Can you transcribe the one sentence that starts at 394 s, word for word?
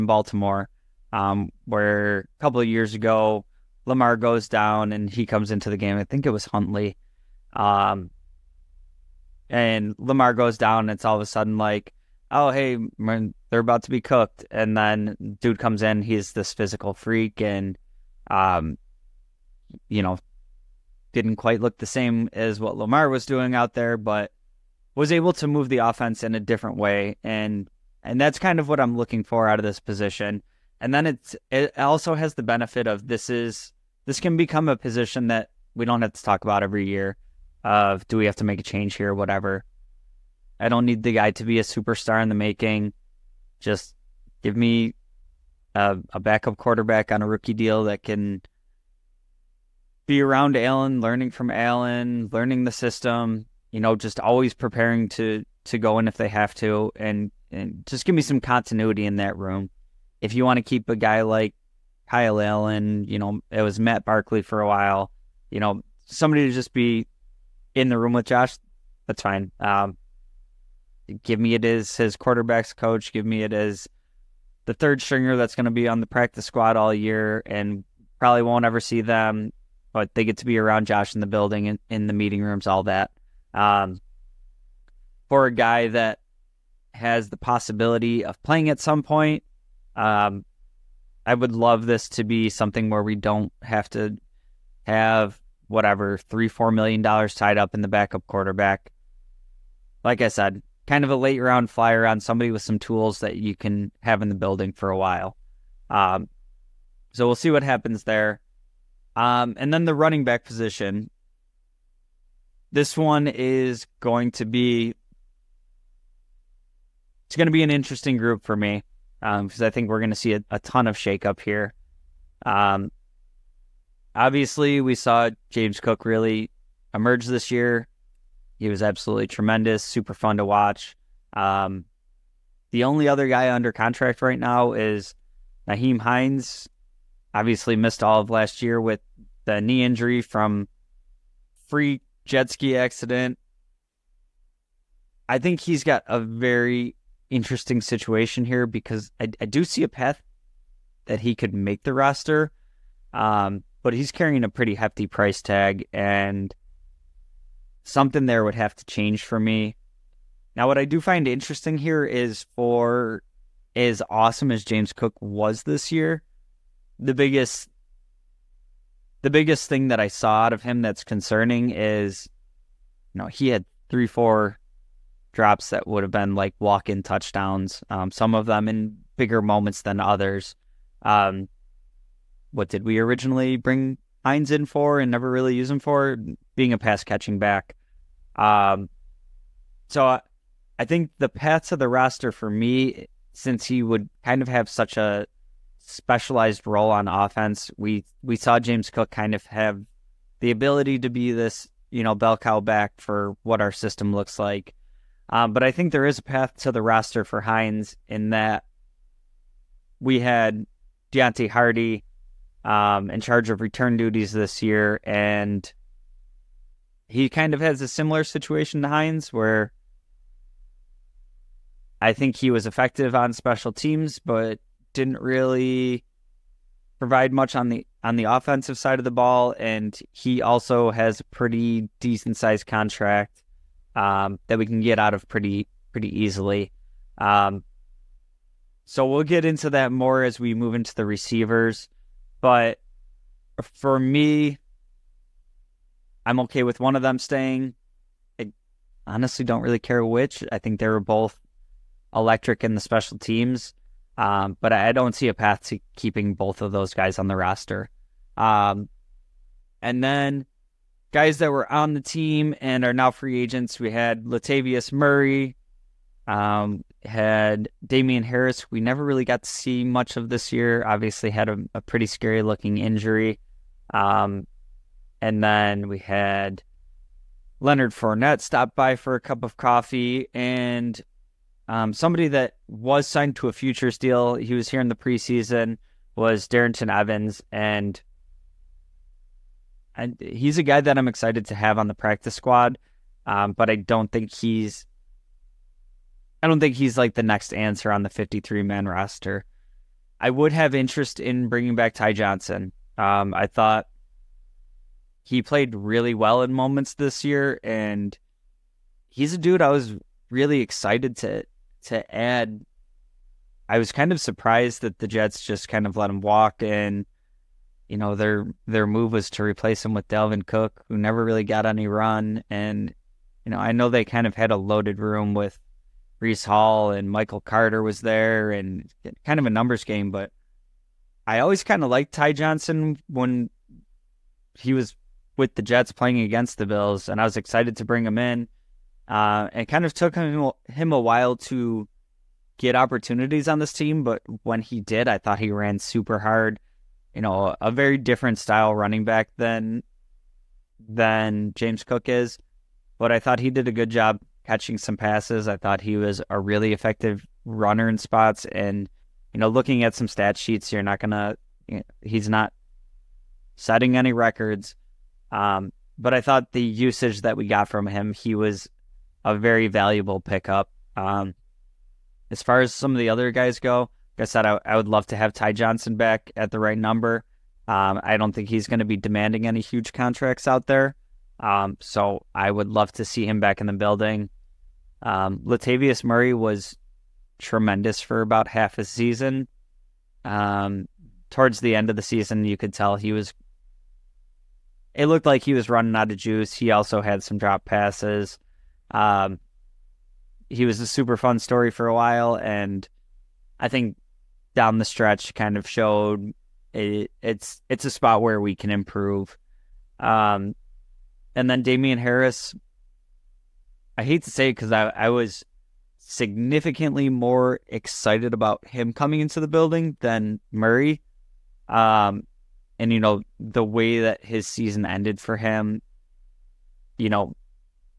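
It looked like he was running out of juice.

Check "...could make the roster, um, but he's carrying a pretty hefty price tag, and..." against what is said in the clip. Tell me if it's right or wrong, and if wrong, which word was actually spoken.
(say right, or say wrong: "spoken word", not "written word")
right.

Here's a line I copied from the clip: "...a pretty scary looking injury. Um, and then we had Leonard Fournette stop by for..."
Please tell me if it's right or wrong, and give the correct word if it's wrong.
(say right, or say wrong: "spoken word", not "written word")
right.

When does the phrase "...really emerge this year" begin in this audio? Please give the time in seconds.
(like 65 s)
126 s.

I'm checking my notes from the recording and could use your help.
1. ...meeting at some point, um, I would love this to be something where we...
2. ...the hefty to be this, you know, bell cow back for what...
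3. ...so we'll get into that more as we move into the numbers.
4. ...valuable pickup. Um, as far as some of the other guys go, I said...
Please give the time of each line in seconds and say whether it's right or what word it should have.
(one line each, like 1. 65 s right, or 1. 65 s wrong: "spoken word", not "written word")
1. 88 s wrong: "playing", not "meeting"
2. 200 s wrong: "ability", not "hefty"
3. 238 s wrong: "receivers", not "numbers"
4. 369 s right.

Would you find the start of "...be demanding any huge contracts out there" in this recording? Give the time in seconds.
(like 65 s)
378 s.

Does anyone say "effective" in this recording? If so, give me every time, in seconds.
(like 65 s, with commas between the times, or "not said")
222 s, 356 s.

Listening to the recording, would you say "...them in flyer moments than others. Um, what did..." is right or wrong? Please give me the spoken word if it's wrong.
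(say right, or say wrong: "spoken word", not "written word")
wrong: "bigger", not "flyer".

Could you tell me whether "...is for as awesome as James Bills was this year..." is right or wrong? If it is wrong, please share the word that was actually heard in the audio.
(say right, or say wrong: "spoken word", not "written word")
wrong: "Cook", not "Bills".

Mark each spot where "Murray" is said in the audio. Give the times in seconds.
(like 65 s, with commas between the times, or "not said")
264 s, 386 s, 420 s.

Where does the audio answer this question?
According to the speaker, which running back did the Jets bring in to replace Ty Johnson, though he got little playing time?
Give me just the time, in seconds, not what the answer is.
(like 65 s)
320 s.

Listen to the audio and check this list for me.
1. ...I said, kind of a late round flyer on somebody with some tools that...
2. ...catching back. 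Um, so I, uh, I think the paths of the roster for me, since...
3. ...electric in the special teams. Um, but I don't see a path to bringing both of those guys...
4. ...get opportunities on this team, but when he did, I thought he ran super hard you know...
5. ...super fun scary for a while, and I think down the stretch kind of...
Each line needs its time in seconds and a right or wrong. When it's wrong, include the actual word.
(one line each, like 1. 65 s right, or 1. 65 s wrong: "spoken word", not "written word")
1. 100 s right
2. 187 s right
3. 252 s wrong: "keeping", not "bringing"
4. 342 s right
5. 400 s wrong: "story", not "scary".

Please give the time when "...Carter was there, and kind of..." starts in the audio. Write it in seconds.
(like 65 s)
327 s.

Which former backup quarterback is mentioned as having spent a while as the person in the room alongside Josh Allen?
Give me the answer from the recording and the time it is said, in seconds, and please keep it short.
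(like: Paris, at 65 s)
Matt Barkley, at 63 s.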